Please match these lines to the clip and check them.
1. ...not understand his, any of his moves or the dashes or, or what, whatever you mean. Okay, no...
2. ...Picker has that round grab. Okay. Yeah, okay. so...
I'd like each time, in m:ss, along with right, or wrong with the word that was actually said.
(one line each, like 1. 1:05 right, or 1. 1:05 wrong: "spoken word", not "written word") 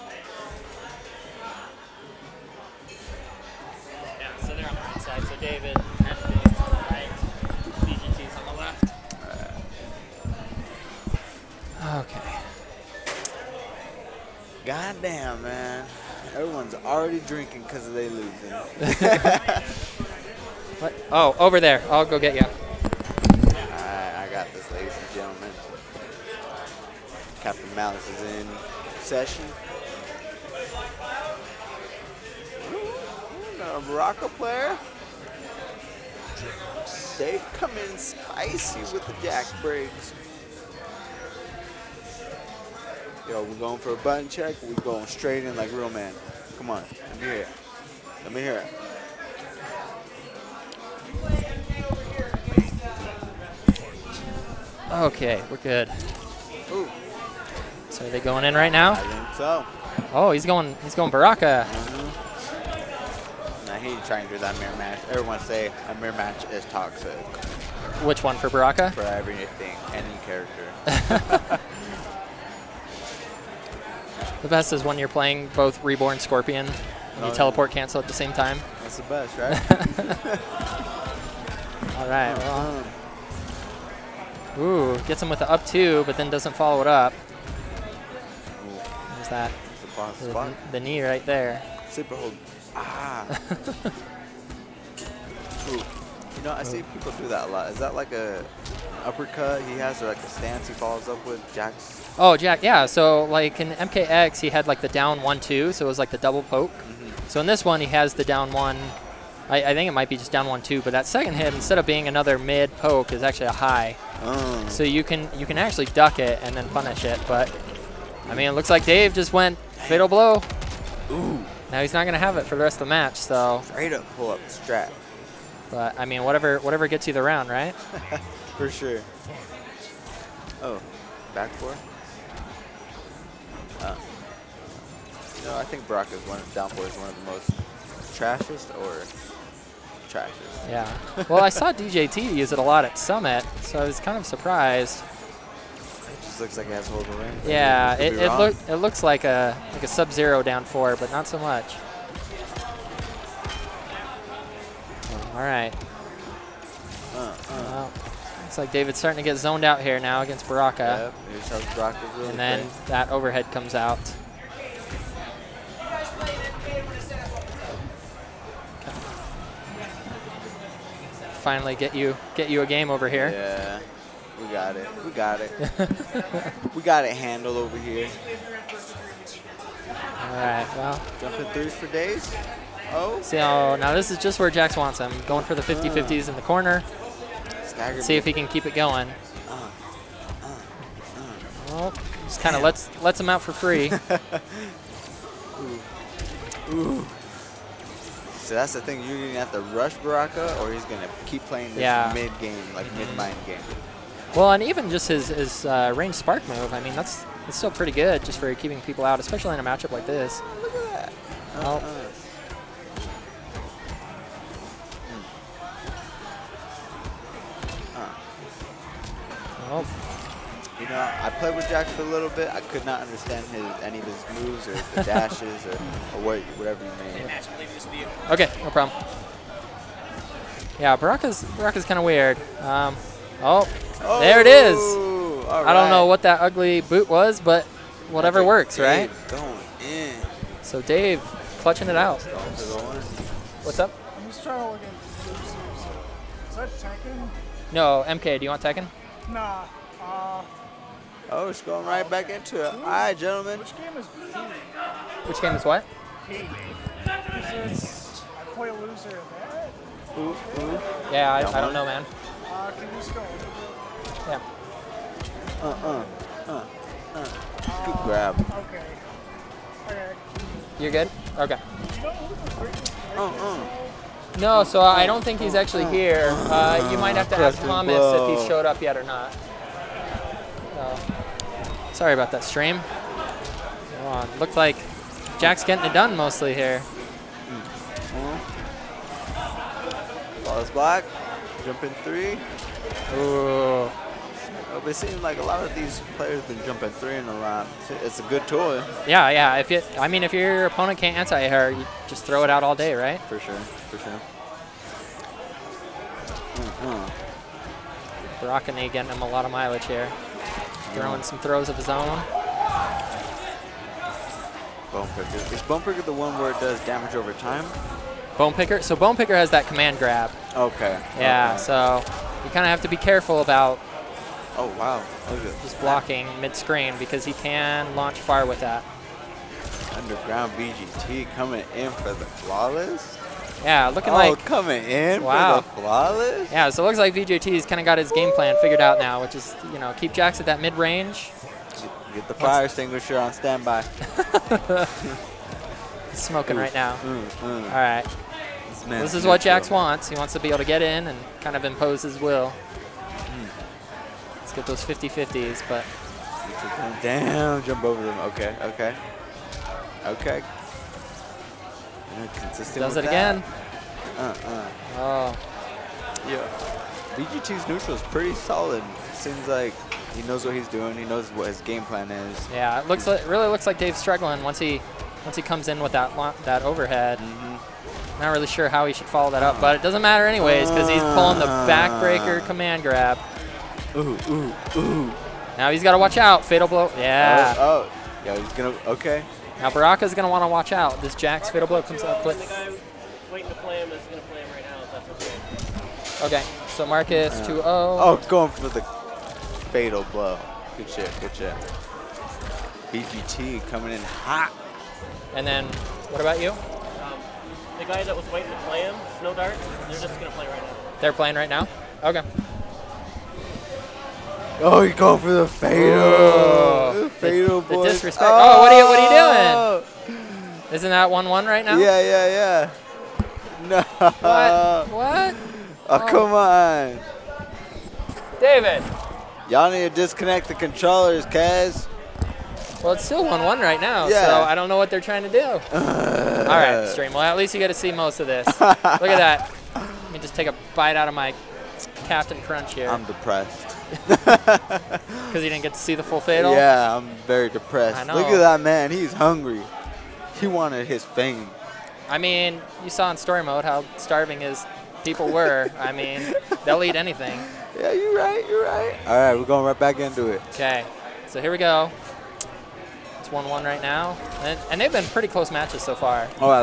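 1. 3:42 right
2. 5:19 wrong: "command", not "round".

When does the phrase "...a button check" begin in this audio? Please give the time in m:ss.
0:43.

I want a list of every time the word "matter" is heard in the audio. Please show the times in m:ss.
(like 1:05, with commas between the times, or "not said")
6:20.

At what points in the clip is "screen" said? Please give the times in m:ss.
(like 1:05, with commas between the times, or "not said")
5:26.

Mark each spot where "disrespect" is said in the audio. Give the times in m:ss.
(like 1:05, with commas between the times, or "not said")
6:57.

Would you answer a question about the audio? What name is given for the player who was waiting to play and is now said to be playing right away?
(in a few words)
Snow Dart.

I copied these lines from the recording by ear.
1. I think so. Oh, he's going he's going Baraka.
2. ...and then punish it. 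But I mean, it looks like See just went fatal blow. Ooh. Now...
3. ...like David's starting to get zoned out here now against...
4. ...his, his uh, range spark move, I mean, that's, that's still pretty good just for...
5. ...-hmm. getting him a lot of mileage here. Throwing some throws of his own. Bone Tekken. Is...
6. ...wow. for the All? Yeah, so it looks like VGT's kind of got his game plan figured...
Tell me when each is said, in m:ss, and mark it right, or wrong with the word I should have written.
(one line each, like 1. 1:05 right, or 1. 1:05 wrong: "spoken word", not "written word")
1. 0:58 right
2. 1:56 wrong: "Dave", not "See"
3. 2:38 right
4. 3:25 right
5. 5:06 wrong: "Pricker", not "Tekken"
6. 5:35 wrong: "Flawless", not "All".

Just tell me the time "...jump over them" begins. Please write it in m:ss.
5:57.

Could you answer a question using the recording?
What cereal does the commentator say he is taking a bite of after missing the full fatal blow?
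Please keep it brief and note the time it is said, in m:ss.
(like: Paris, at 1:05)
Captain Crunch, at 7:22.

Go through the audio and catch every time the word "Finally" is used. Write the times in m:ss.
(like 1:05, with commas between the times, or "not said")
2:51.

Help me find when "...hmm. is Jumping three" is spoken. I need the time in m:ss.
4:50.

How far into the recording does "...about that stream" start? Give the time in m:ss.
4:42.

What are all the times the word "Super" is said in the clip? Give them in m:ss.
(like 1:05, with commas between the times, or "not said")
1:31.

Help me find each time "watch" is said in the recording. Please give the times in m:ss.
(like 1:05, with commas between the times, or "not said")
6:25, 6:30.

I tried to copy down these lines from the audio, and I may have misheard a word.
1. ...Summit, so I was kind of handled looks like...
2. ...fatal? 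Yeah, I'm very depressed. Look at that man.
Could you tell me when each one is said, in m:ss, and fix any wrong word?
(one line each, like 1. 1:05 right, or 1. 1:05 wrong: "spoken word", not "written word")
1. 2:22 wrong: "surprised", not "handled"
2. 7:26 right.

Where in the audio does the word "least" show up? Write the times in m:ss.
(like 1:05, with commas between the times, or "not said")
7:17.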